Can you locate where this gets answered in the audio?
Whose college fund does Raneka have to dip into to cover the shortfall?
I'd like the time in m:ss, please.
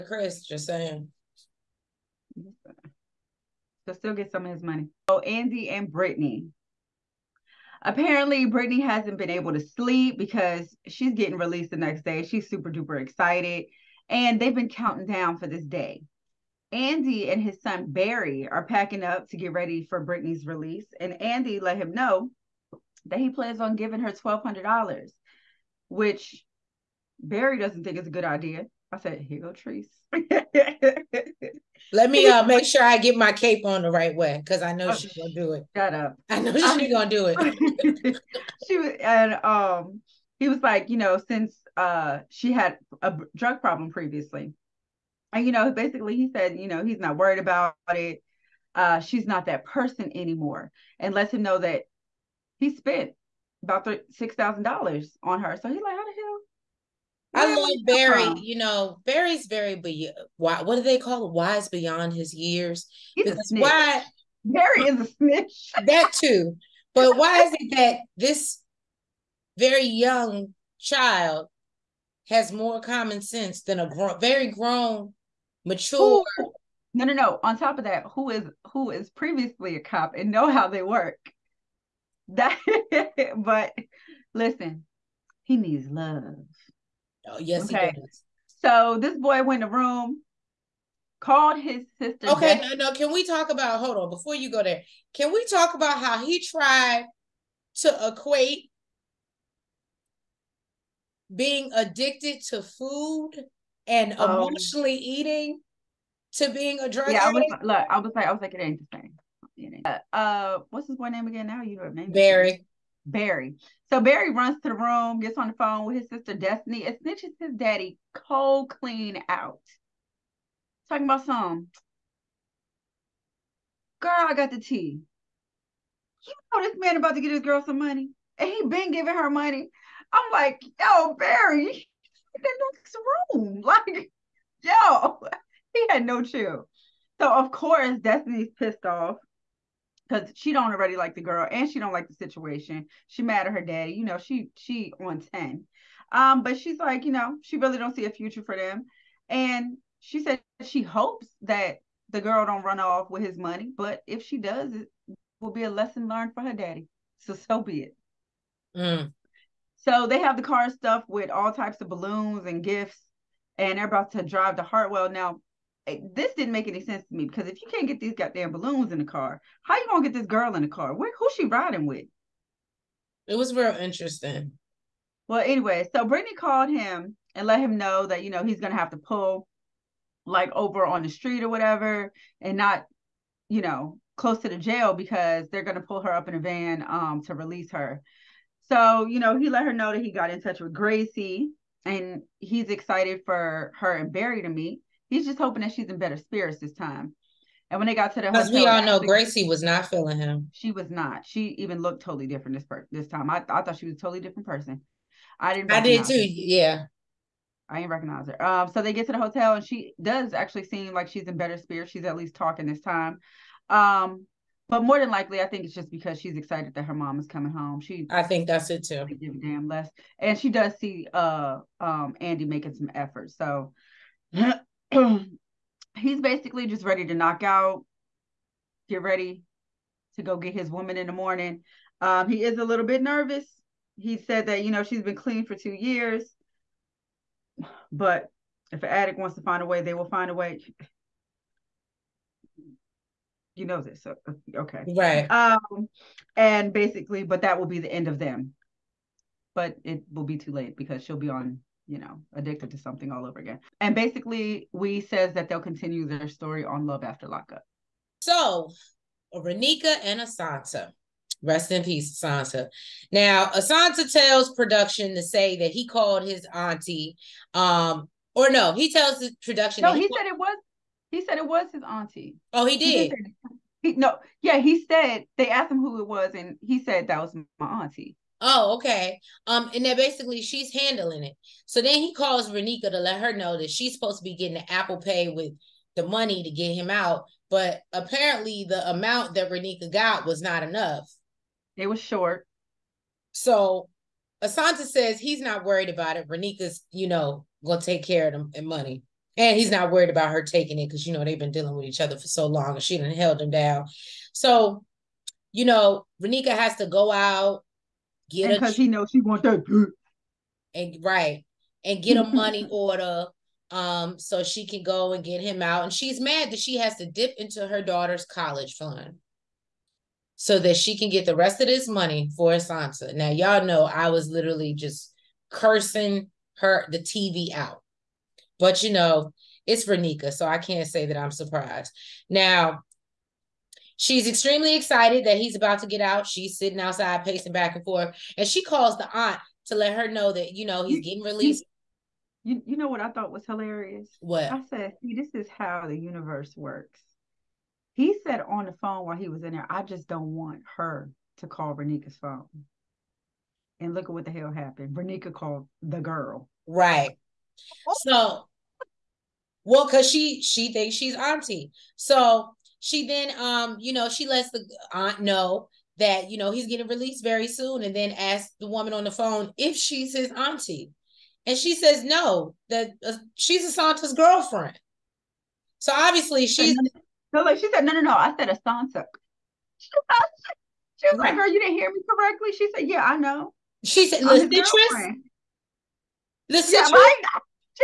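5:17.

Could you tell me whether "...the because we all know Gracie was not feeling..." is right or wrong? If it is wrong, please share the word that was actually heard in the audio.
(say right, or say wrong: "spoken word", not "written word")
right.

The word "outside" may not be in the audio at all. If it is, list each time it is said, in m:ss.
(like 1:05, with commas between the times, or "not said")
5:36.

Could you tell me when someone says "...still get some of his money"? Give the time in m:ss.
0:03.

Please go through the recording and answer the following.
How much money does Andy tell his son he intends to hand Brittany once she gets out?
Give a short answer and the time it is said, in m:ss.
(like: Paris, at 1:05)
$1,200, at 0:24.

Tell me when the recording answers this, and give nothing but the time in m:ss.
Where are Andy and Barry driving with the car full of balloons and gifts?
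2:44.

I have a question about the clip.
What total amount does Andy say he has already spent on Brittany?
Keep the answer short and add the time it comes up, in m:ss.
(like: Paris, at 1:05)
$6,000, at 0:54.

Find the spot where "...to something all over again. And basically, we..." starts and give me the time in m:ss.
4:12.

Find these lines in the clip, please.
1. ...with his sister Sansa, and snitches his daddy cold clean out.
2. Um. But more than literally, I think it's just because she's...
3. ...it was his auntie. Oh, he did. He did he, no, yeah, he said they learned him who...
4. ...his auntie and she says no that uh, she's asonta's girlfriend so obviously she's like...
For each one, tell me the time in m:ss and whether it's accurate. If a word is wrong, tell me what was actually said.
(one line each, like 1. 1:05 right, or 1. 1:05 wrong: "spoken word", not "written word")
1. 1:55 wrong: "Destiny", not "Sansa"
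2. 3:33 wrong: "likely", not "literally"
3. 4:31 wrong: "asked", not "learned"
4. 6:10 right.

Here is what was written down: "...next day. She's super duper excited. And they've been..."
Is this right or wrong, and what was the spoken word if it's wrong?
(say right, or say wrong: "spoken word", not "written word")
right.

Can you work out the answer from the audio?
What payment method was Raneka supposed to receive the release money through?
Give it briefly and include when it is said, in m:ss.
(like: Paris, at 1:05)
Apple Pay, at 4:44.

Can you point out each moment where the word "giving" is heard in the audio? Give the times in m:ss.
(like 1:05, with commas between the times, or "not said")
0:23, 2:08.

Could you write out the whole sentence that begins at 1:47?
I was, look, I was like, I was like, it ain't the same.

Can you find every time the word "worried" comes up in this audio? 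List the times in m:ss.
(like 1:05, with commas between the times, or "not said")
0:47, 4:55, 4:59.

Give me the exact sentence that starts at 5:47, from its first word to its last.
He said on the phone while he was in there, I just don't want her to call Raneka's phone.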